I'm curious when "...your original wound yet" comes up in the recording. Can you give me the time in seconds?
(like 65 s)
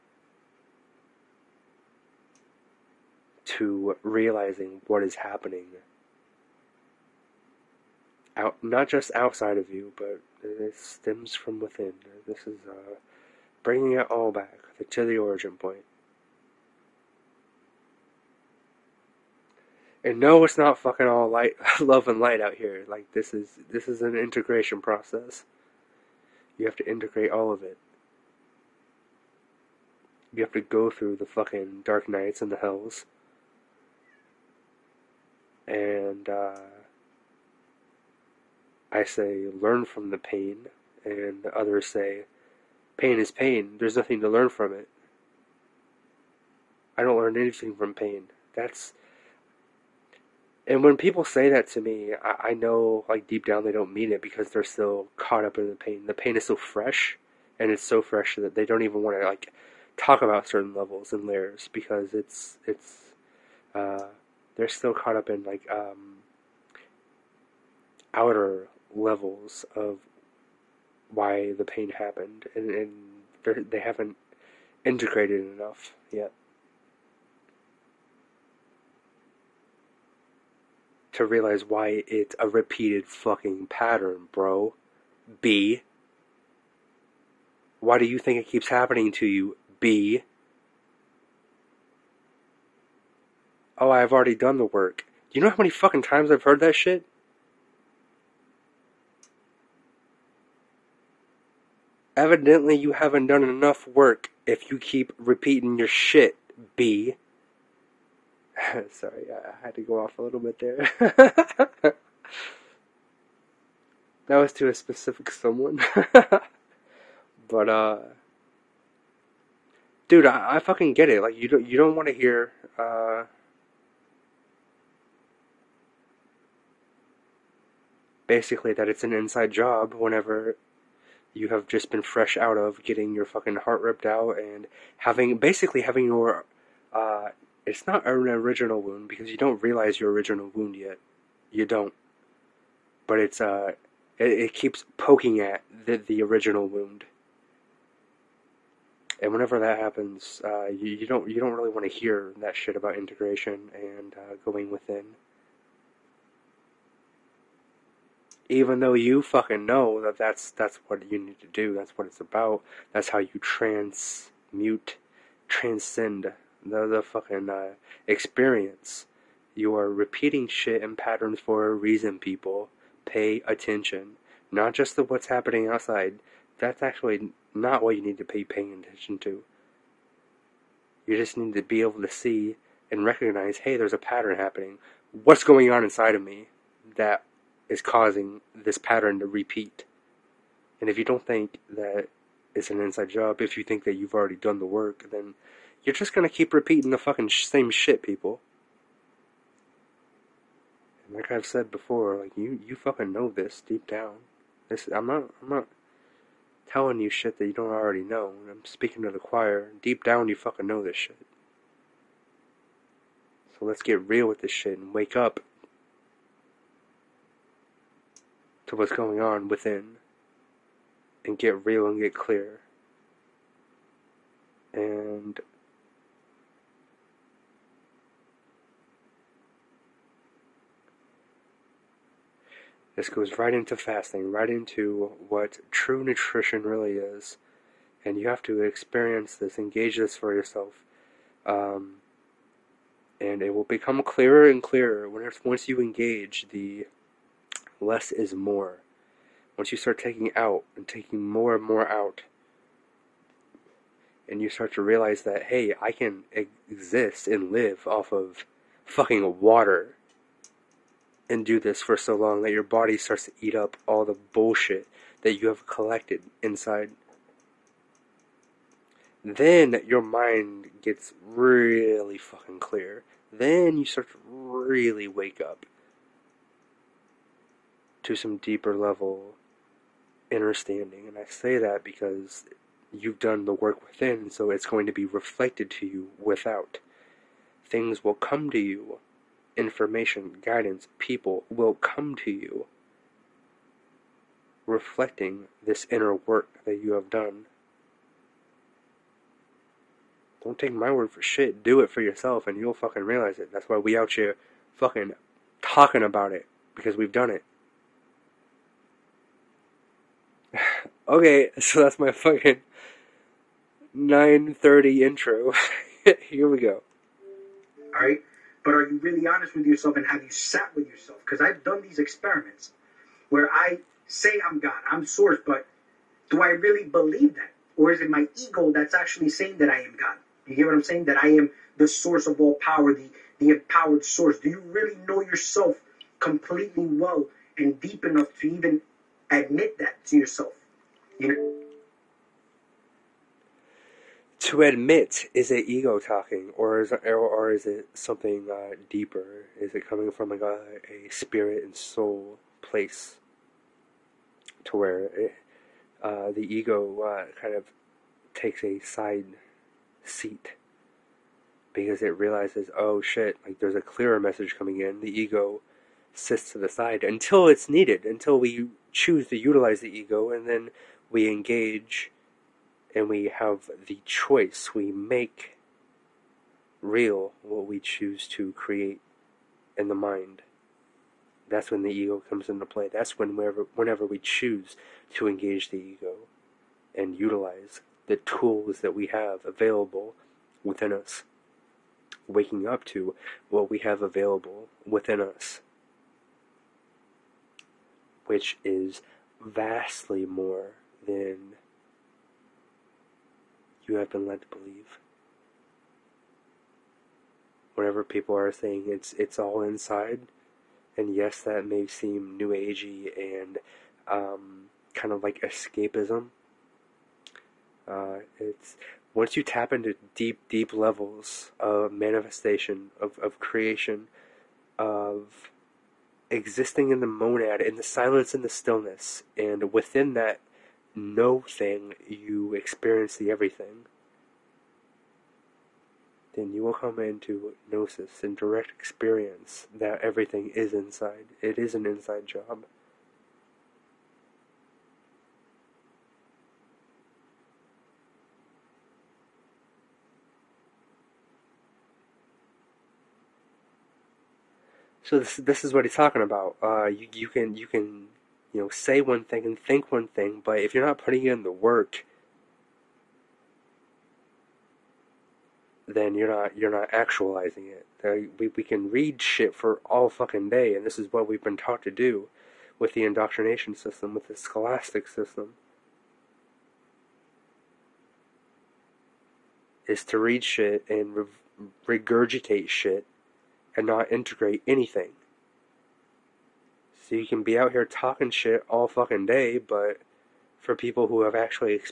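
139 s.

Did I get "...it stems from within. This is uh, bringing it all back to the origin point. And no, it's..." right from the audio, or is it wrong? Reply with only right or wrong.
right.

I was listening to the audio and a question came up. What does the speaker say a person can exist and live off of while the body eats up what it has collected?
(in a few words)
water.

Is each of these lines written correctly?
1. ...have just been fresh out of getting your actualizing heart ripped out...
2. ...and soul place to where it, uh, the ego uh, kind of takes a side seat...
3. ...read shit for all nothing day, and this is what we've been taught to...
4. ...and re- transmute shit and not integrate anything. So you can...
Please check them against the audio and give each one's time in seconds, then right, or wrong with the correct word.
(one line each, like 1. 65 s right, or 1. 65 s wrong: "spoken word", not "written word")
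1. 131 s wrong: "fucking", not "actualizing"
2. 351 s right
3. 468 s wrong: "fucking", not "nothing"
4. 480 s wrong: "regurgitate", not "transmute".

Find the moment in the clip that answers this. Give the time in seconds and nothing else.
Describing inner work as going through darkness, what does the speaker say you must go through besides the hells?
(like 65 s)
31 s.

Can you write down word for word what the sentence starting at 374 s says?
We make real what we choose to create in the mind.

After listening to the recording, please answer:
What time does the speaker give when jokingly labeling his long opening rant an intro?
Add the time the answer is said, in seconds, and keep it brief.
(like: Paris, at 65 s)
9:30, at 313 s.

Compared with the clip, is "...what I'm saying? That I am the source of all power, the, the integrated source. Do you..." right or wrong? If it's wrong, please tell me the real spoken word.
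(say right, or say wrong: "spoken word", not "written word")
wrong: "empowered", not "integrated".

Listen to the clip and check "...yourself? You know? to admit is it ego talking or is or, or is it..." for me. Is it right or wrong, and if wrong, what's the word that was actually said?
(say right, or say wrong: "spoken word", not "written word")
right.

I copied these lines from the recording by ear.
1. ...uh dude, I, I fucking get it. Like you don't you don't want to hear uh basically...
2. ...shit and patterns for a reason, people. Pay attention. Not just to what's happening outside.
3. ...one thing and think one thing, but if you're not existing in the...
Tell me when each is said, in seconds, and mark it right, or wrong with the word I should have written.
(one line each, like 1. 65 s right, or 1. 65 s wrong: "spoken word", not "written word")
1. 117 s right
2. 170 s right
3. 459 s wrong: "putting", not "existing".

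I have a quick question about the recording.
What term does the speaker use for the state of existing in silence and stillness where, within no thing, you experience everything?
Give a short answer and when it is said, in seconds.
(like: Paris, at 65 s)
the monad, at 427 s.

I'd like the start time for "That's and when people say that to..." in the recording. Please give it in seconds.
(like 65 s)
48 s.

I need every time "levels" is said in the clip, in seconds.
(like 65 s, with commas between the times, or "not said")
60 s, 68 s, 278 s, 420 s.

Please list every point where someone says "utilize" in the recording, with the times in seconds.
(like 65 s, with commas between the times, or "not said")
369 s, 387 s.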